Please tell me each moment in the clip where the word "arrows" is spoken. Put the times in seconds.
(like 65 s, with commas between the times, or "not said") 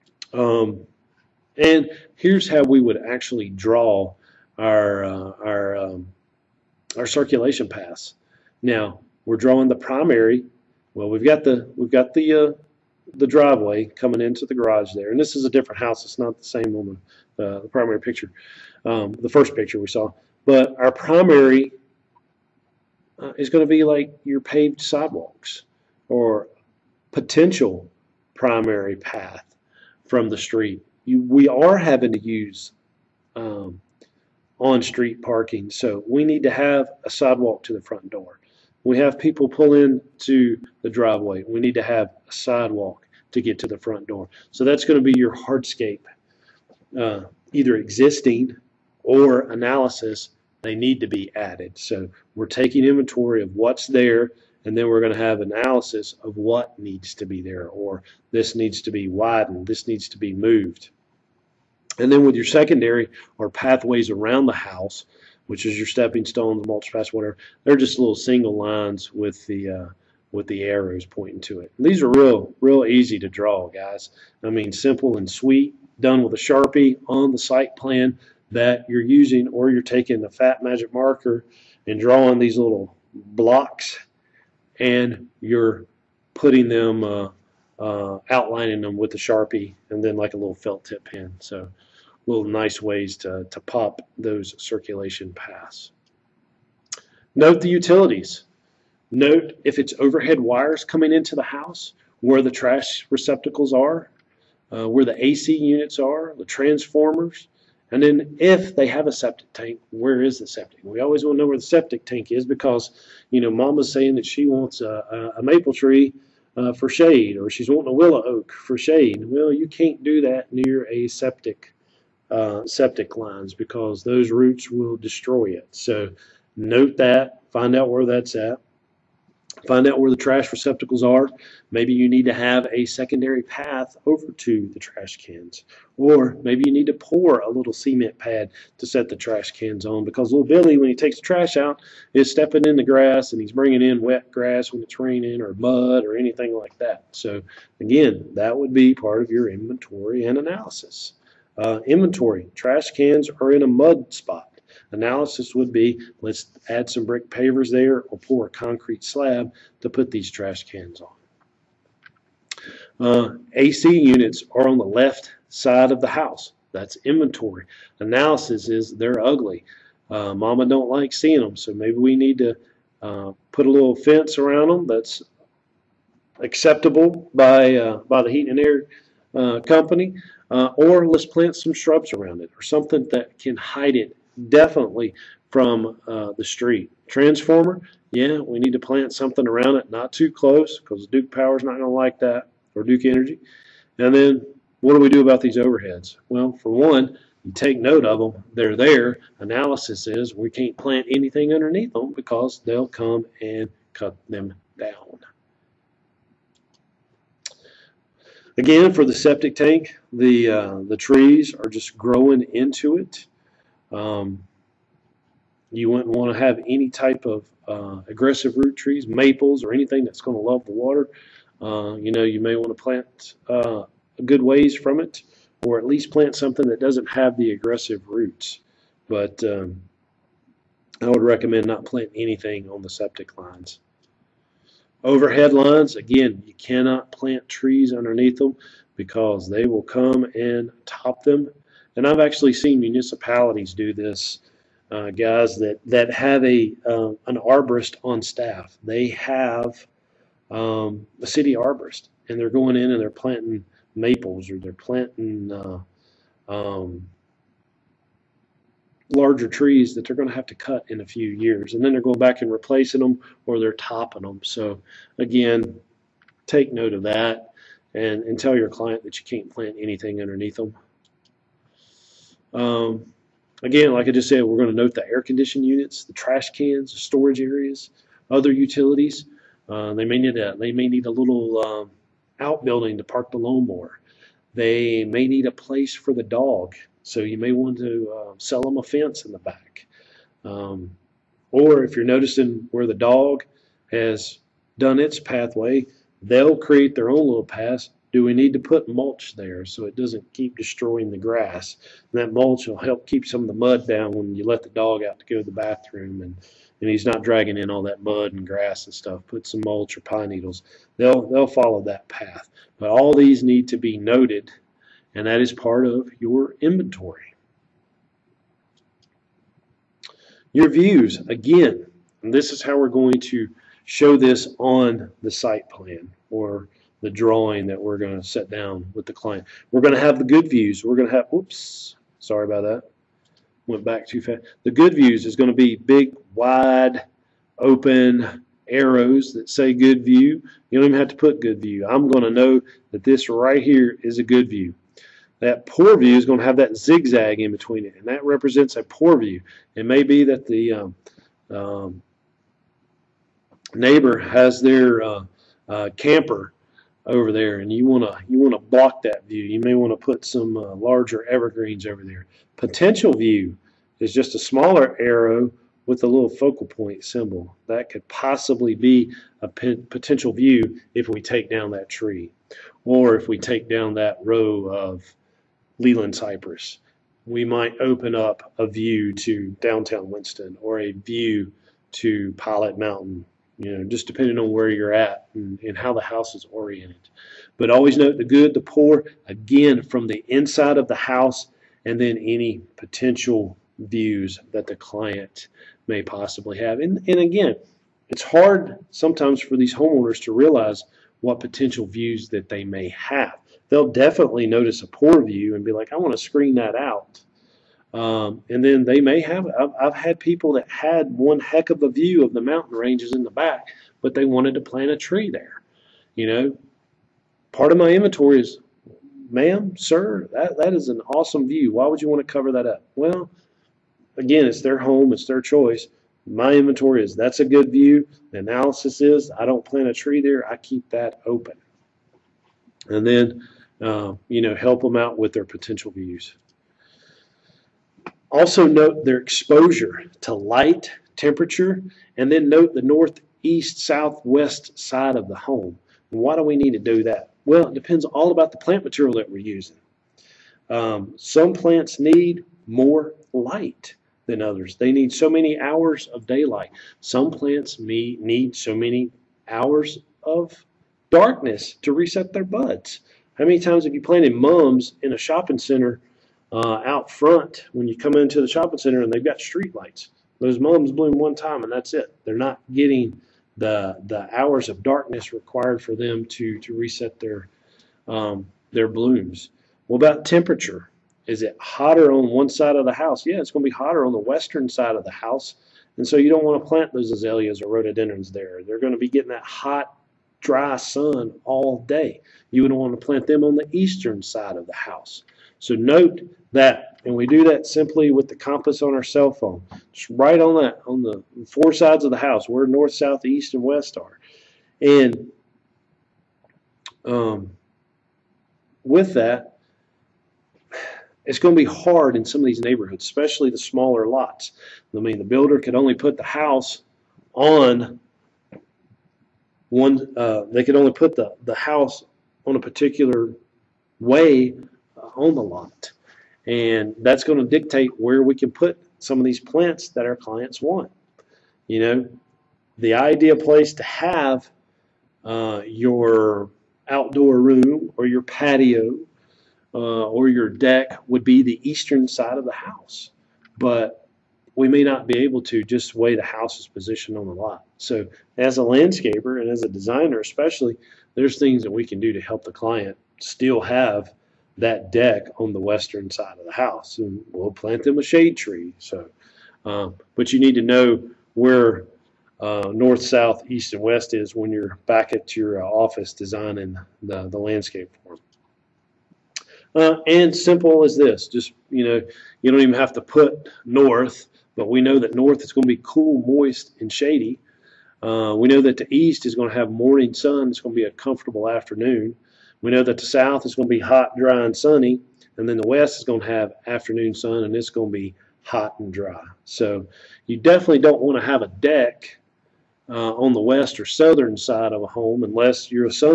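70 s, 338 s, 365 s.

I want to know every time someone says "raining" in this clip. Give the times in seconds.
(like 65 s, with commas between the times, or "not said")
144 s.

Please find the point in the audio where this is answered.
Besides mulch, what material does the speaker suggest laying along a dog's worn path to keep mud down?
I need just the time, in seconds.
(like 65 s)
310 s.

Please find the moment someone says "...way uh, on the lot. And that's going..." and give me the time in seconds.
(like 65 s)
523 s.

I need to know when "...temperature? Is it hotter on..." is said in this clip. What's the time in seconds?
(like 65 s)
480 s.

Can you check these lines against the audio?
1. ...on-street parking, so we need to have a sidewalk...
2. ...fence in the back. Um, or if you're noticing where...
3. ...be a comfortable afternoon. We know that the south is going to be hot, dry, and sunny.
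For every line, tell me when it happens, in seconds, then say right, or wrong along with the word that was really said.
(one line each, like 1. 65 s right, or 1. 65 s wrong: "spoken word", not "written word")
1. 34 s right
2. 288 s right
3. 580 s right.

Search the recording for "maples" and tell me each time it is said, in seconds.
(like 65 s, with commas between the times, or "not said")
115 s, 219 s, 253 s.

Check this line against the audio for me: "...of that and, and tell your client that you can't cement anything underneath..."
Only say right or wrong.
wrong.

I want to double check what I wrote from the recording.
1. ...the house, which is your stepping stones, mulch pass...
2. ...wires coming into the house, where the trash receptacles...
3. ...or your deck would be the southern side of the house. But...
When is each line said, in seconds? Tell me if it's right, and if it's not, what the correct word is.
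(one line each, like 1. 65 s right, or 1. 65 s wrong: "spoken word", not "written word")
1. 64 s right
2. 100 s right
3. 540 s wrong: "eastern", not "southern".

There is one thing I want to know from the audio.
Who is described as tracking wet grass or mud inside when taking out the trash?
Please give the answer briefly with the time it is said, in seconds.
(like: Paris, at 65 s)
Little Billy, at 140 s.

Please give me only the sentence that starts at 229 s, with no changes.
But um, I would recommend not planting anything on the septic lines.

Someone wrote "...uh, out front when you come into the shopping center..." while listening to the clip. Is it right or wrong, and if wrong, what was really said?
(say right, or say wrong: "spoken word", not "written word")
right.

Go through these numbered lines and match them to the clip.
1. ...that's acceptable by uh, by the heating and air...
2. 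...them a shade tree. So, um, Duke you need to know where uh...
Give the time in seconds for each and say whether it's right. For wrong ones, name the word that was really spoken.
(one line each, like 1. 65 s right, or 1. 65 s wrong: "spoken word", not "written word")
1. 174 s right
2. 557 s wrong: "But", not "Duke".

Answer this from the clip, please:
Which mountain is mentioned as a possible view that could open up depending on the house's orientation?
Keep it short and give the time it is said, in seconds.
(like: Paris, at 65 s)
Pilot Mountain, at 382 s.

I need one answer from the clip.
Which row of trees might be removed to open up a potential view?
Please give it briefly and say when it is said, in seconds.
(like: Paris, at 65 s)
Leyland Cypress, at 375 s.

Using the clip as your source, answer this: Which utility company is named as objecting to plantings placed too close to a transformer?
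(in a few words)
Duke Energy.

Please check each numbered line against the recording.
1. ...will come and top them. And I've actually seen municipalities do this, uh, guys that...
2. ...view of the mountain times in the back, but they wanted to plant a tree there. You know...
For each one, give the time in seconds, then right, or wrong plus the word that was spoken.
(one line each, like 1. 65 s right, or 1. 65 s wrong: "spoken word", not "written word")
1. 239 s right
2. 411 s wrong: "ranges", not "times".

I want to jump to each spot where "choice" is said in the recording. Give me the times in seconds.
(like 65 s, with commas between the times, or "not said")
425 s.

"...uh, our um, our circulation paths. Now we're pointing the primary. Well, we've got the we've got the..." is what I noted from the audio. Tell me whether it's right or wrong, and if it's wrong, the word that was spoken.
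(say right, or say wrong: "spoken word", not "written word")
wrong: "drawing", not "pointing".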